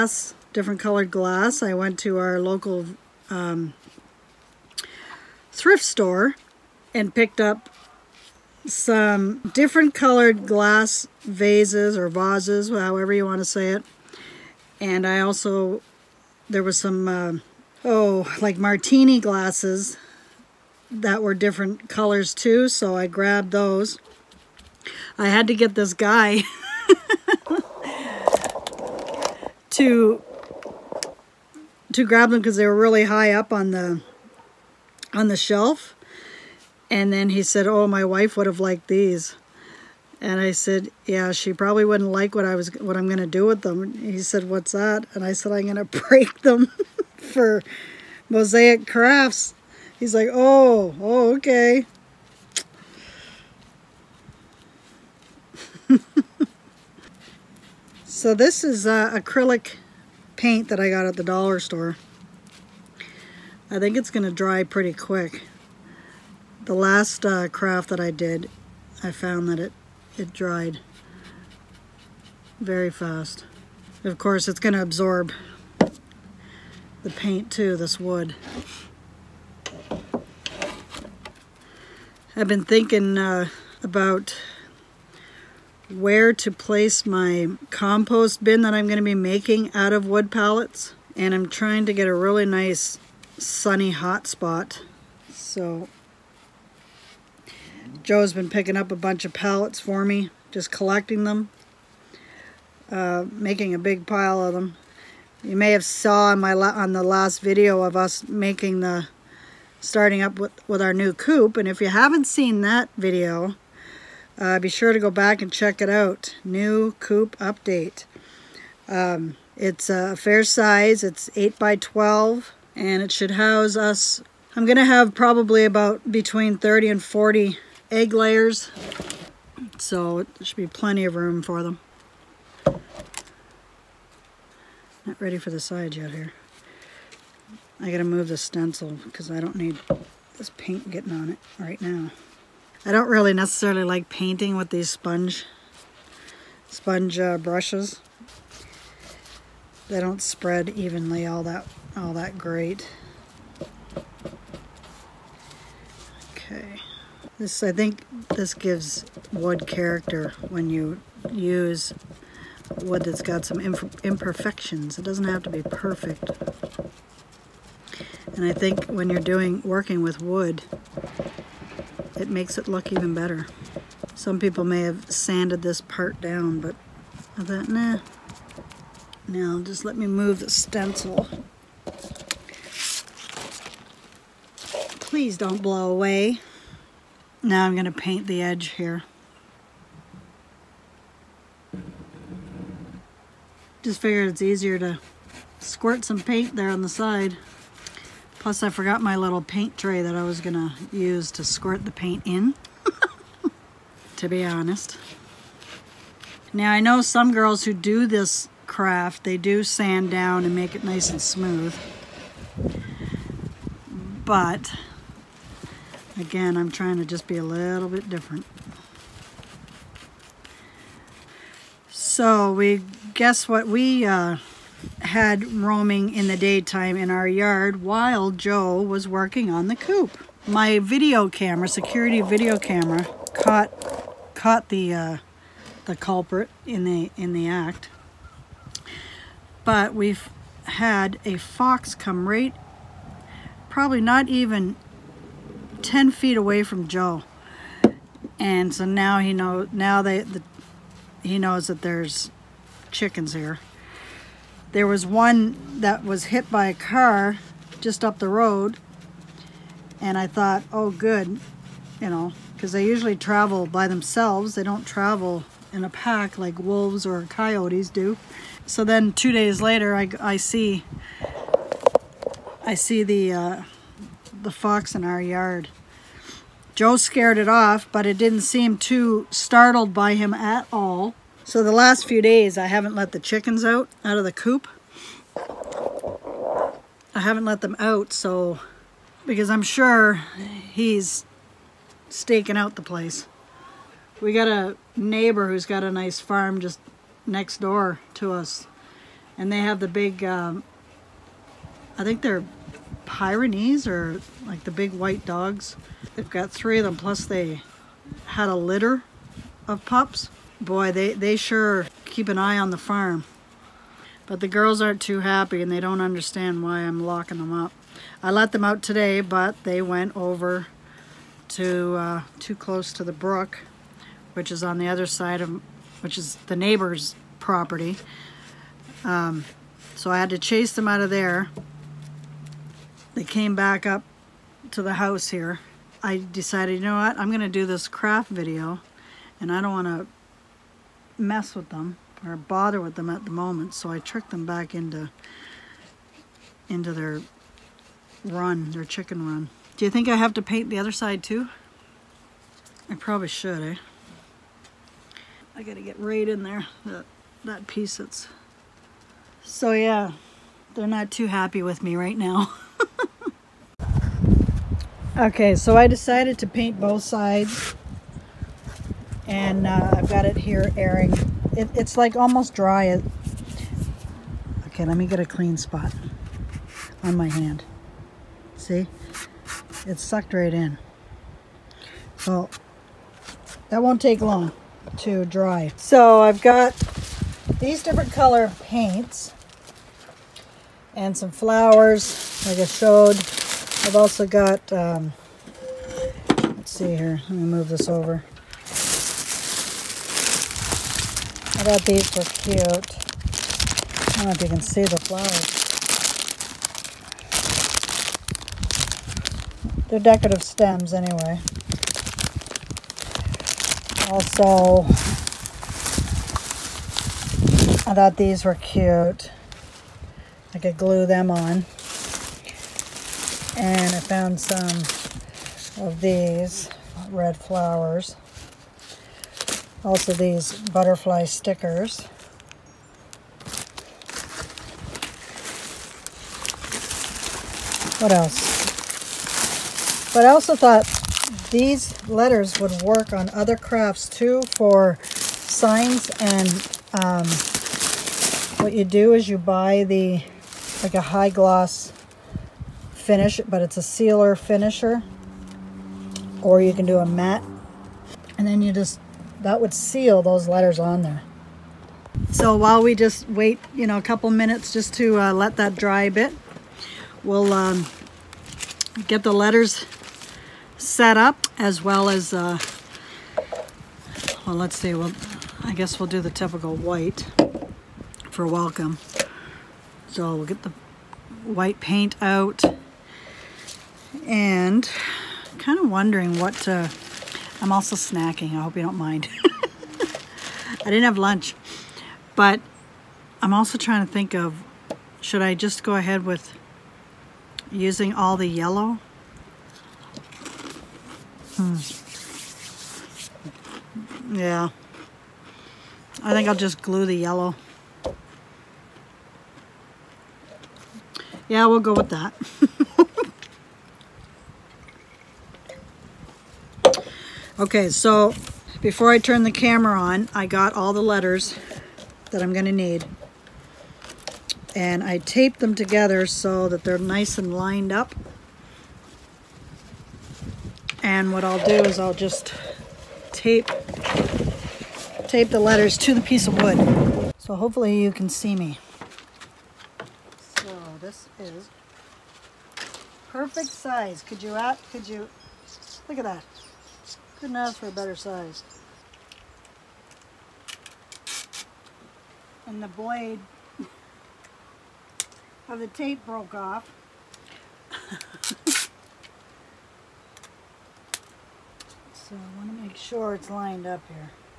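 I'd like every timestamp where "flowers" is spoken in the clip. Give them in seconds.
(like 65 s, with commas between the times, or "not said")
391 s, 404 s, 427 s.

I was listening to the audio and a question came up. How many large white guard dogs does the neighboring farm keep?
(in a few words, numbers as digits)
3.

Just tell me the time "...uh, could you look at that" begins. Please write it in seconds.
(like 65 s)
544 s.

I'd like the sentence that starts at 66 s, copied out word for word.
The last uh, craft that I did, I found that it, it dried very fast.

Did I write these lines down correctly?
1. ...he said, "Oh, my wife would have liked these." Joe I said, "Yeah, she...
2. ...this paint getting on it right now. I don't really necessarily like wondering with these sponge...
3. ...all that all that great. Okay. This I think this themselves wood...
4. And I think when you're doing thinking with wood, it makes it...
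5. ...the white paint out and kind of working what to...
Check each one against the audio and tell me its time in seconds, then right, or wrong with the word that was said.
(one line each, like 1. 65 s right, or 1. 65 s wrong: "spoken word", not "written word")
1. 37 s wrong: "And", not "Joe"
2. 140 s wrong: "painting", not "wondering"
3. 151 s wrong: "gives", not "themselves"
4. 168 s wrong: "working", not "thinking"
5. 480 s wrong: "wondering", not "working".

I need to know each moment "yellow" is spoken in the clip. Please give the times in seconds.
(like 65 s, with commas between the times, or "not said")
498 s, 507 s.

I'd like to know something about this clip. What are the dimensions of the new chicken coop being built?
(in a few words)
8 by 12.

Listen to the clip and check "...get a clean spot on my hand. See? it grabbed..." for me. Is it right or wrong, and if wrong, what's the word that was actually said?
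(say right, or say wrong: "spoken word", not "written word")
wrong: "sucked", not "grabbed".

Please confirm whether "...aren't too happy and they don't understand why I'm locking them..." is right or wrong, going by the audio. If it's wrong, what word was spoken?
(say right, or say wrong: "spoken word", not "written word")
right.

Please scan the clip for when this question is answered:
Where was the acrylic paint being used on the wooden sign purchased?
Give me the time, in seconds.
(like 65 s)
61 s.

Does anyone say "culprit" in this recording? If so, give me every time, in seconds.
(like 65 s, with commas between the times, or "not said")
235 s.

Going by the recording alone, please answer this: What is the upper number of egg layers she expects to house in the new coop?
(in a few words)
40.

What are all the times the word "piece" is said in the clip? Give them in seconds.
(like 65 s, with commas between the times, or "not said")
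357 s, 536 s.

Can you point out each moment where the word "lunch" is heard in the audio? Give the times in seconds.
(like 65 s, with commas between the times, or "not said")
491 s.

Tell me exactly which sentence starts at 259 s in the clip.
And I thought, oh, good, you know, because they usually travel by themselves.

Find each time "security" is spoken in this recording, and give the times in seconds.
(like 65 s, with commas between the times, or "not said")
231 s.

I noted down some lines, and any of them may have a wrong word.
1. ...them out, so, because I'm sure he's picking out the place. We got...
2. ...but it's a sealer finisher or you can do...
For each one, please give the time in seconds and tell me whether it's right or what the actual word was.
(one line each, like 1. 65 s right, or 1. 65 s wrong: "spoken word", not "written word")
1. 287 s wrong: "staking", not "picking"
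2. 453 s right.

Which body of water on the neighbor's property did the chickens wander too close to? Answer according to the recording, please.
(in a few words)
the brook.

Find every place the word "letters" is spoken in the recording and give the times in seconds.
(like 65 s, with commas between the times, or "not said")
442 s, 460 s, 469 s, 521 s, 535 s.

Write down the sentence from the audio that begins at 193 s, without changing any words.
Just figured it's easier to squirt some paint there on the side.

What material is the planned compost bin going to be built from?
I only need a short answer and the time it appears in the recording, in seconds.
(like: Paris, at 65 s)
wood pallets, at 90 s.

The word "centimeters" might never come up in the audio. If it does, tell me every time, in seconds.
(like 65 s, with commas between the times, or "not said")
not said.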